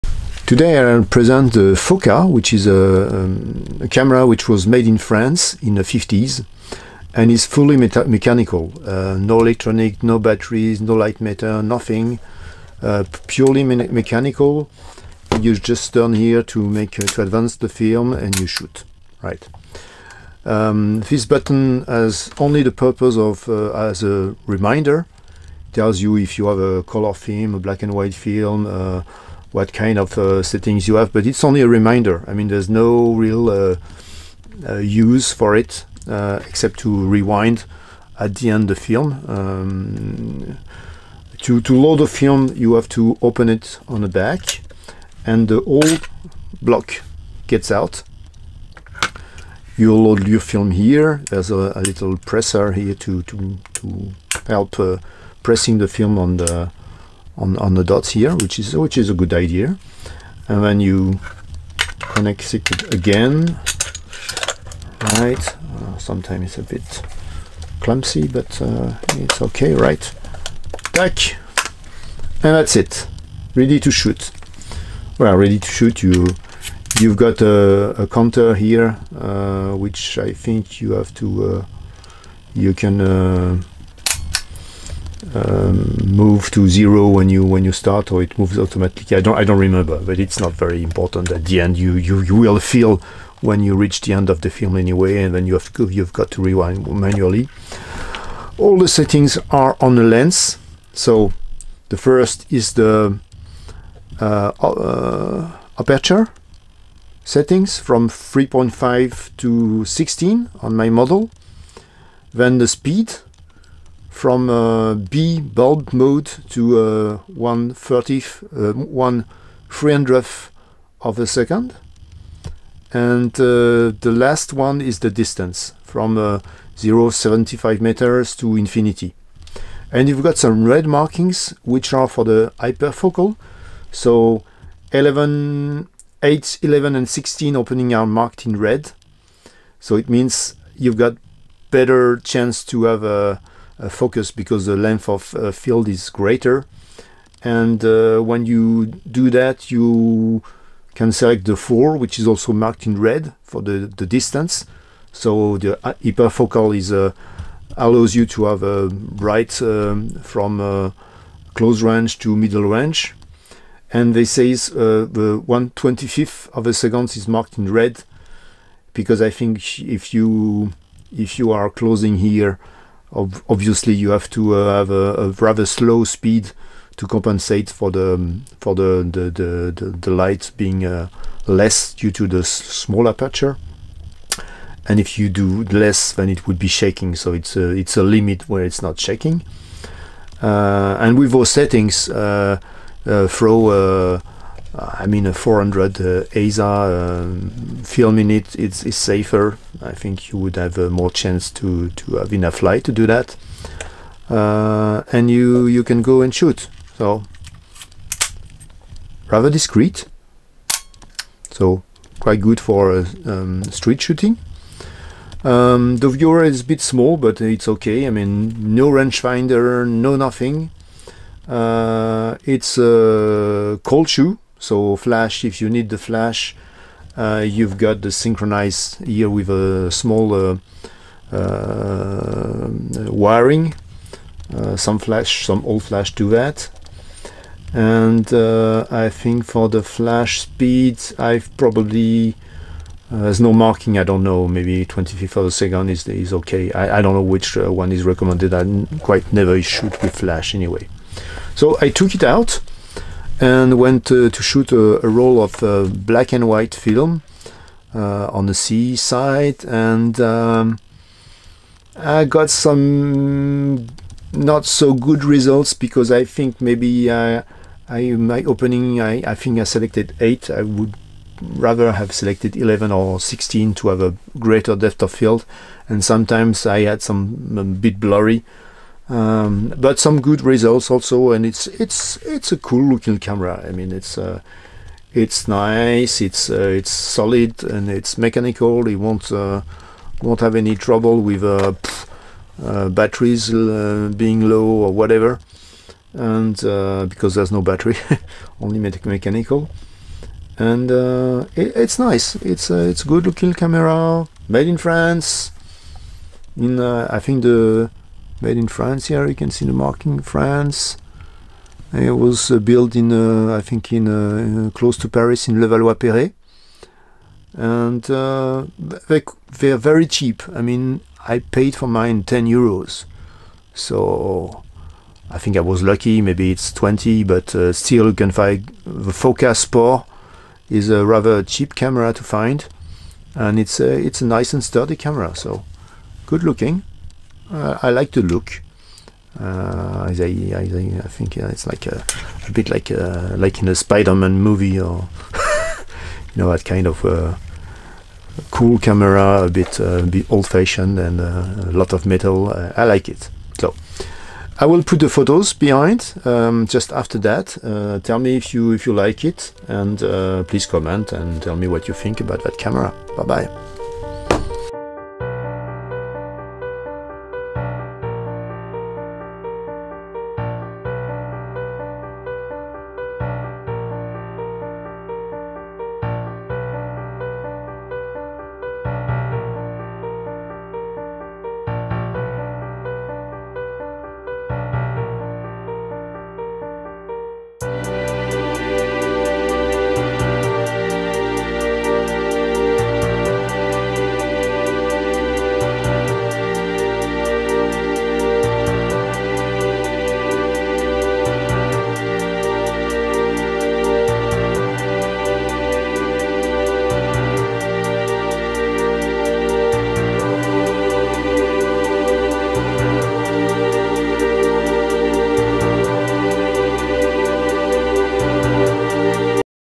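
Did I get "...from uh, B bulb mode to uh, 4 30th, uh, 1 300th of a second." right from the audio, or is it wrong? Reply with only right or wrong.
wrong.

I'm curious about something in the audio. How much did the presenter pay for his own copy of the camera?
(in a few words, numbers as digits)
10 euros.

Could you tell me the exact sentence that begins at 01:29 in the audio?
I don't I don't remember, but it's not very important.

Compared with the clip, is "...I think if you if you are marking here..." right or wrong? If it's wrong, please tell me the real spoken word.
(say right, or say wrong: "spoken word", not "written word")
wrong: "closing", not "marking".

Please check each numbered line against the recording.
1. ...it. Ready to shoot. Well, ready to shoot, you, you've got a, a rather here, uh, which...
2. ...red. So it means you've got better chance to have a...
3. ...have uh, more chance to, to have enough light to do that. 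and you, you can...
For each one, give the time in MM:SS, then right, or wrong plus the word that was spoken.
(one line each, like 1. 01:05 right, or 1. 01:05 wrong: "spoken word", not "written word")
1. 01:12 wrong: "counter", not "rather"
2. 02:18 right
3. 03:20 right.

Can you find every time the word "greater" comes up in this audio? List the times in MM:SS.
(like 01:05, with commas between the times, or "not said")
02:26, 04:34.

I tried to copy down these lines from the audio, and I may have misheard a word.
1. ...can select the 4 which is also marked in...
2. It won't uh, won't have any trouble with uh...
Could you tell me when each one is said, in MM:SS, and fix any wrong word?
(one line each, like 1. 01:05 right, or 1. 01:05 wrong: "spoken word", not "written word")
1. 02:30 right
2. 04:48 right.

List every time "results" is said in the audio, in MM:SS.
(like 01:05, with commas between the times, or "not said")
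04:25, 04:40.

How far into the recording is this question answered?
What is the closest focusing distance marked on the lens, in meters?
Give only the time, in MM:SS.
02:06.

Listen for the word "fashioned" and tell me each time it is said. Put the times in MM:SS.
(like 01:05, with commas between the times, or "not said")
05:50.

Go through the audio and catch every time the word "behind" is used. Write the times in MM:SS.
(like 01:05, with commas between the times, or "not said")
05:55.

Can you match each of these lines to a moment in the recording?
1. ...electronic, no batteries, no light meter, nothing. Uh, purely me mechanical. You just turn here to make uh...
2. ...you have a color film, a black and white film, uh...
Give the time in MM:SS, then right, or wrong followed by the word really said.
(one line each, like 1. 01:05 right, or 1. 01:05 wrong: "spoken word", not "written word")
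1. 00:09 right
2. 00:26 right.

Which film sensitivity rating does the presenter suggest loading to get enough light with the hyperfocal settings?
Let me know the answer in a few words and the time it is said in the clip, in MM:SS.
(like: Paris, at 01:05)
400 ASA, at 03:15.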